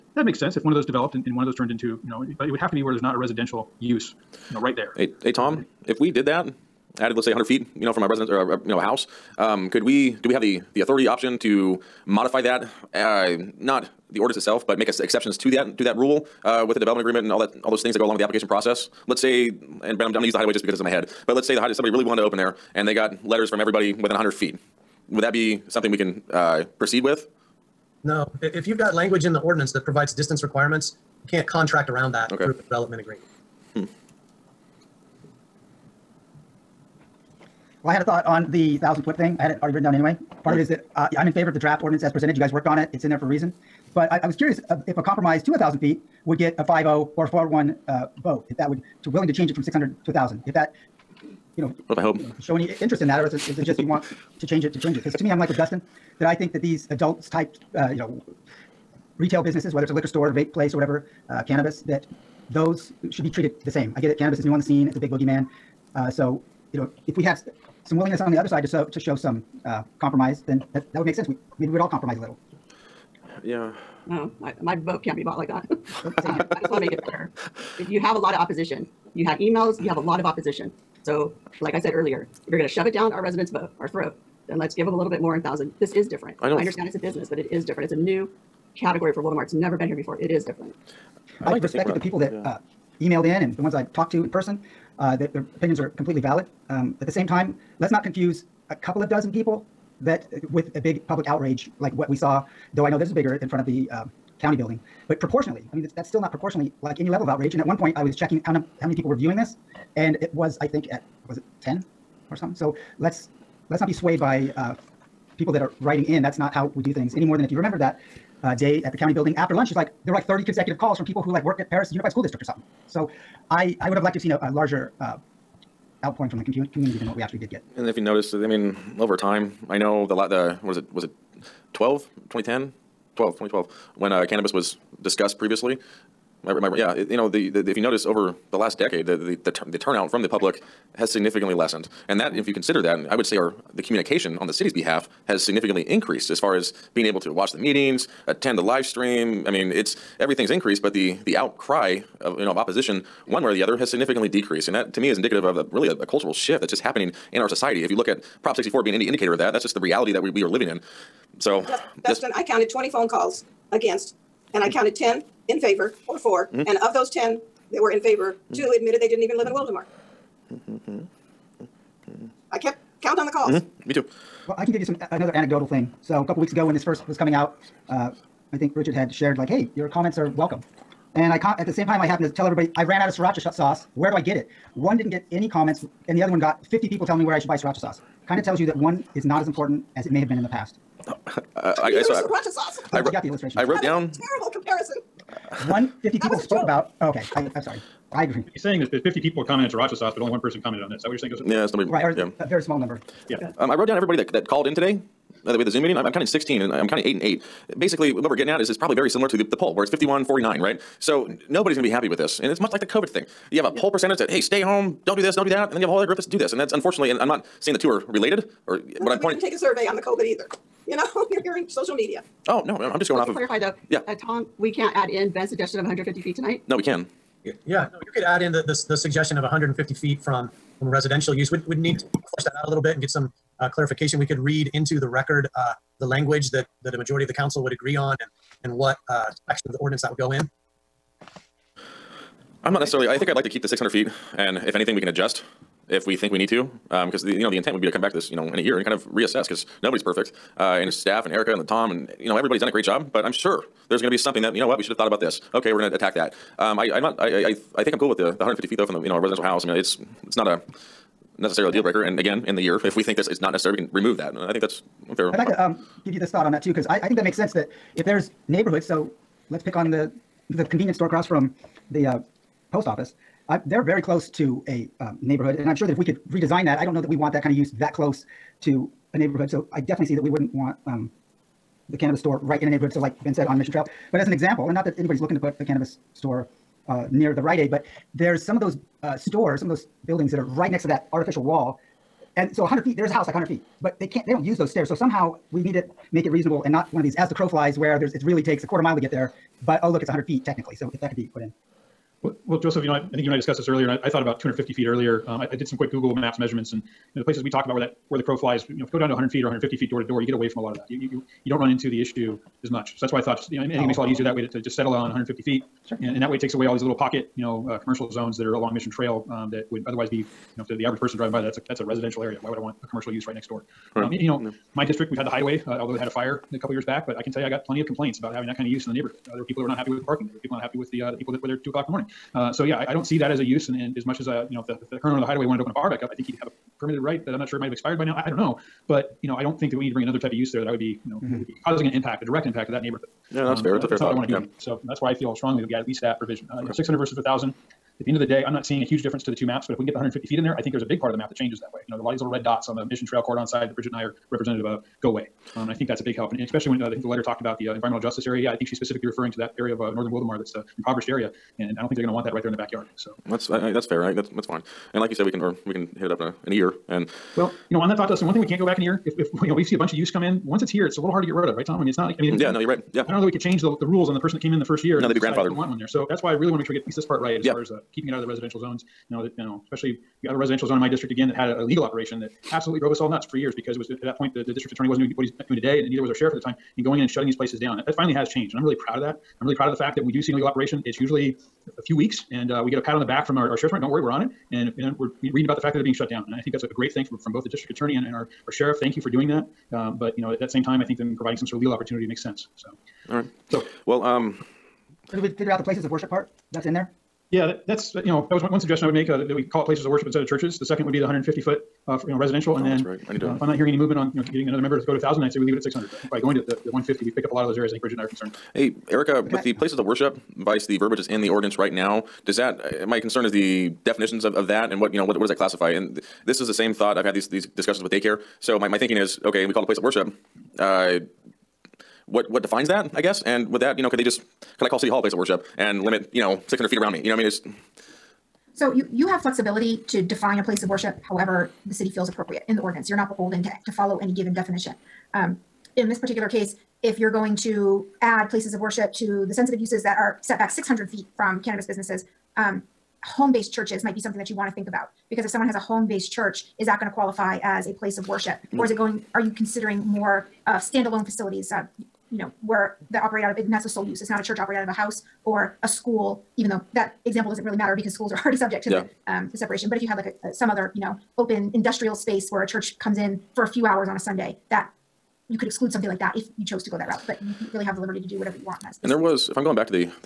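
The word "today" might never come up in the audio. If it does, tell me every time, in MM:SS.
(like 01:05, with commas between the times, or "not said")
03:24, 06:25.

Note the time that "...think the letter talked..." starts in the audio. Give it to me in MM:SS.
05:56.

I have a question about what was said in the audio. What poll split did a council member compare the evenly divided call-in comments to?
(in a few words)
51-49.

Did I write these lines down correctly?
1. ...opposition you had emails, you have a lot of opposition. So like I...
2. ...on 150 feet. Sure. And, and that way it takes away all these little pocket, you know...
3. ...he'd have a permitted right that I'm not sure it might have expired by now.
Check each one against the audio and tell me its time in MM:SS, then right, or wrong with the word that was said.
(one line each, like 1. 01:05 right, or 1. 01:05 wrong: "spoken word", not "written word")
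1. 01:18 right
2. 05:14 right
3. 05:36 right.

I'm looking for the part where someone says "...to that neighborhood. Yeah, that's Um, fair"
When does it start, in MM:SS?
05:42.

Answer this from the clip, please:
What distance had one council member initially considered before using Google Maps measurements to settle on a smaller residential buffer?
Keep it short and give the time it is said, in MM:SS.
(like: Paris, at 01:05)
250 feet, at 05:04.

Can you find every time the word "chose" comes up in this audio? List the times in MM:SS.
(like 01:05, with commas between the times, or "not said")
07:56.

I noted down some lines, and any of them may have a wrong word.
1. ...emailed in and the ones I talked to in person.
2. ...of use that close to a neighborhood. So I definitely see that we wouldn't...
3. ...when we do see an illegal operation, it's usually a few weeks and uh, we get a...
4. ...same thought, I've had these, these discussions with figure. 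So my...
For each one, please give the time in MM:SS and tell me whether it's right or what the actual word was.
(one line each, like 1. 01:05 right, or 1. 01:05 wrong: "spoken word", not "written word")
1. 01:33 right
2. 04:37 right
3. 06:30 right
4. 07:06 wrong: "daycare", not "figure".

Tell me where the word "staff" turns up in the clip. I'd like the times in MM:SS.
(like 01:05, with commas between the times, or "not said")
04:10.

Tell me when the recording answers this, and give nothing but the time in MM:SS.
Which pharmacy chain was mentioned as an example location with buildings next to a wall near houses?
04:47.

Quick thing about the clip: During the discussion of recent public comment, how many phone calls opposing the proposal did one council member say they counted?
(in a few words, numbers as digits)
20.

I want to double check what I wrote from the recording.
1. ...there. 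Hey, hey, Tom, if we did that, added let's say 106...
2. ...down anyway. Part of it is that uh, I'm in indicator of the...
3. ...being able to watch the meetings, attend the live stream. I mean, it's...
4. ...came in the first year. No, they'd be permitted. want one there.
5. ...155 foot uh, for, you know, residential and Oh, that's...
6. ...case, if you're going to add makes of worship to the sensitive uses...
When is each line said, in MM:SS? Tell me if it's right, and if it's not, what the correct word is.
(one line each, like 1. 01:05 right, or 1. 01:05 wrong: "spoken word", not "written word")
1. 00:04 wrong: "100", not "106"
2. 00:39 wrong: "favor", not "indicator"
3. 02:26 right
4. 06:14 wrong: "grandfathered", not "permitted"
5. 06:51 wrong: "150", not "155"
6. 07:26 wrong: "places", not "makes".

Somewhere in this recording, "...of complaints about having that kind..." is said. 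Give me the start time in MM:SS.
05:27.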